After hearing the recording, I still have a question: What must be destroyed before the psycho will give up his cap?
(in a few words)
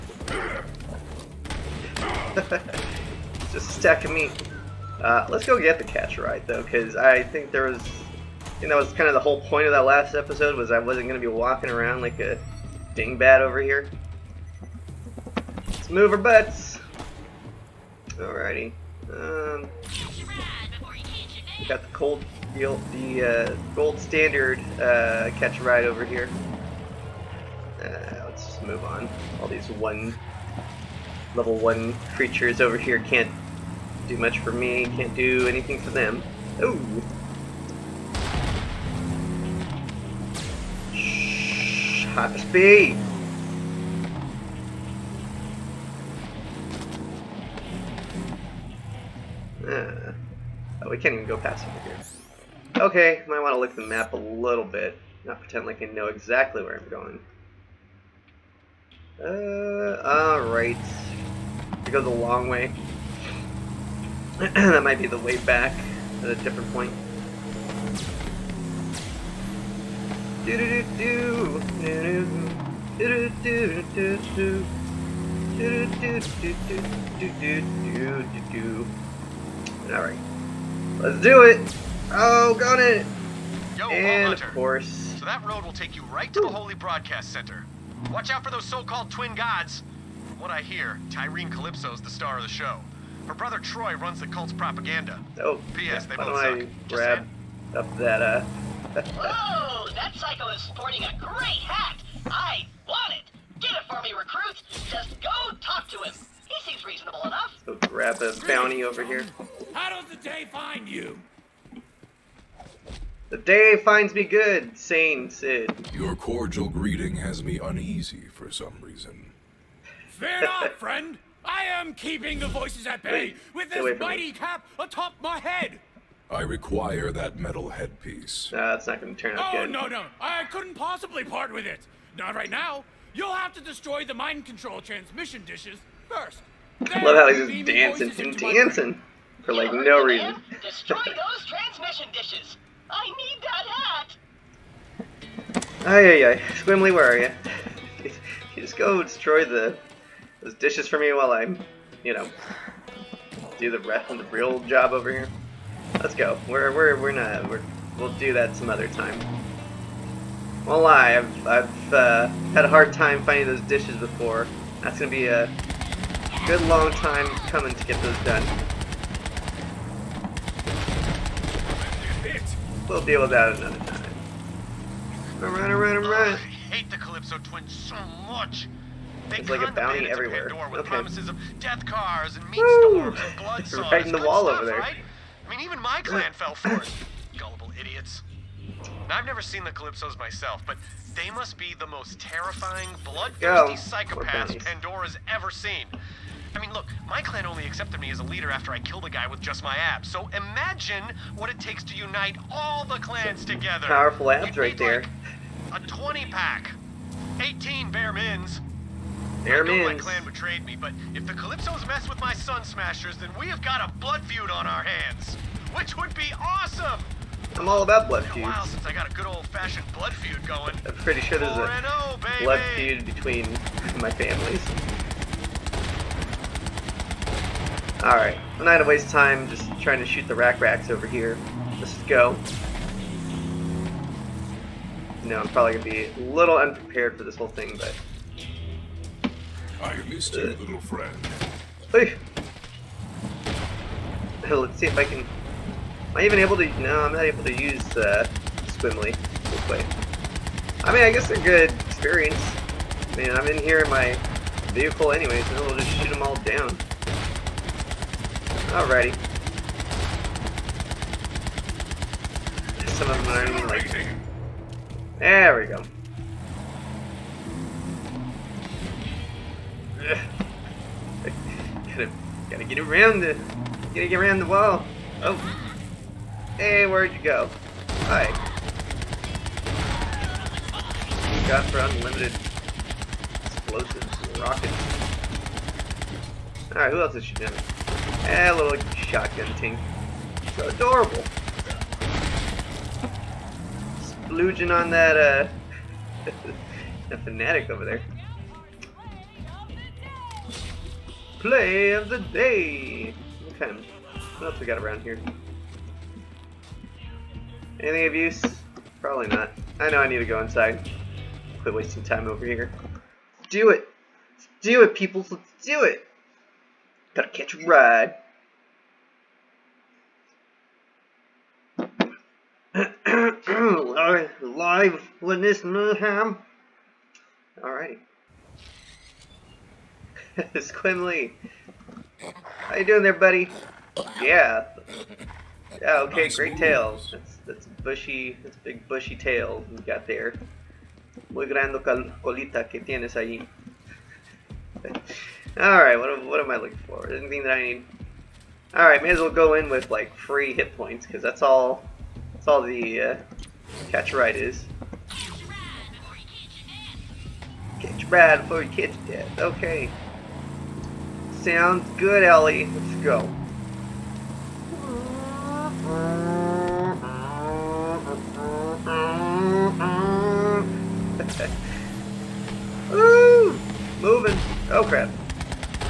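mind control transmission dishes.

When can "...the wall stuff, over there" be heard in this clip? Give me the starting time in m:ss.
3:04.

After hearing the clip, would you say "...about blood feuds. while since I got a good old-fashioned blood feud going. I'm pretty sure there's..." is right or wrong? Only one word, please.
right.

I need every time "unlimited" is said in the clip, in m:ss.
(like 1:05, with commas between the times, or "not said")
4:41.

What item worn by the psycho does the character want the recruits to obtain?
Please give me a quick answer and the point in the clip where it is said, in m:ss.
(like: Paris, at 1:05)
metal headpiece, at 2:07.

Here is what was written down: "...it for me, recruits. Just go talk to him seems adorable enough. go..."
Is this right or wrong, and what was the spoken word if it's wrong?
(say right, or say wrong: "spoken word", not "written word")
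wrong: "reasonable", not "adorable".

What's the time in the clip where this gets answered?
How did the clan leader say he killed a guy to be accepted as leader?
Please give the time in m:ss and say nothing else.
3:19.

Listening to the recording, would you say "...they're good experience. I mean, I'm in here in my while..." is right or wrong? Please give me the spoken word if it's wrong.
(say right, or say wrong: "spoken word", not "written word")
wrong: "vehicle", not "while".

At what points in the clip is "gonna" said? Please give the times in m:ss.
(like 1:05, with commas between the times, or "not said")
2:44, 3:48, 3:55.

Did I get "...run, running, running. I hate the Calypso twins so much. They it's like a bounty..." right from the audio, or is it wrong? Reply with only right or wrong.
right.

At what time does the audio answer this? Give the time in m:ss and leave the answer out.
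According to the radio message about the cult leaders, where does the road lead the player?
1:26.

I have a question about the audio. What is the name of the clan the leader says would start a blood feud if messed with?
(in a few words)
Sun Smashers.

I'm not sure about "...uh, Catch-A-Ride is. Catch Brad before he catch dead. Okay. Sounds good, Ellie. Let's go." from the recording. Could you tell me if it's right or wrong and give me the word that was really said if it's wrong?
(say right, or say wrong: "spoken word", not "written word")
right.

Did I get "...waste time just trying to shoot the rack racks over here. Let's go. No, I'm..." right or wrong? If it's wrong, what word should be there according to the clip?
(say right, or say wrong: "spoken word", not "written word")
right.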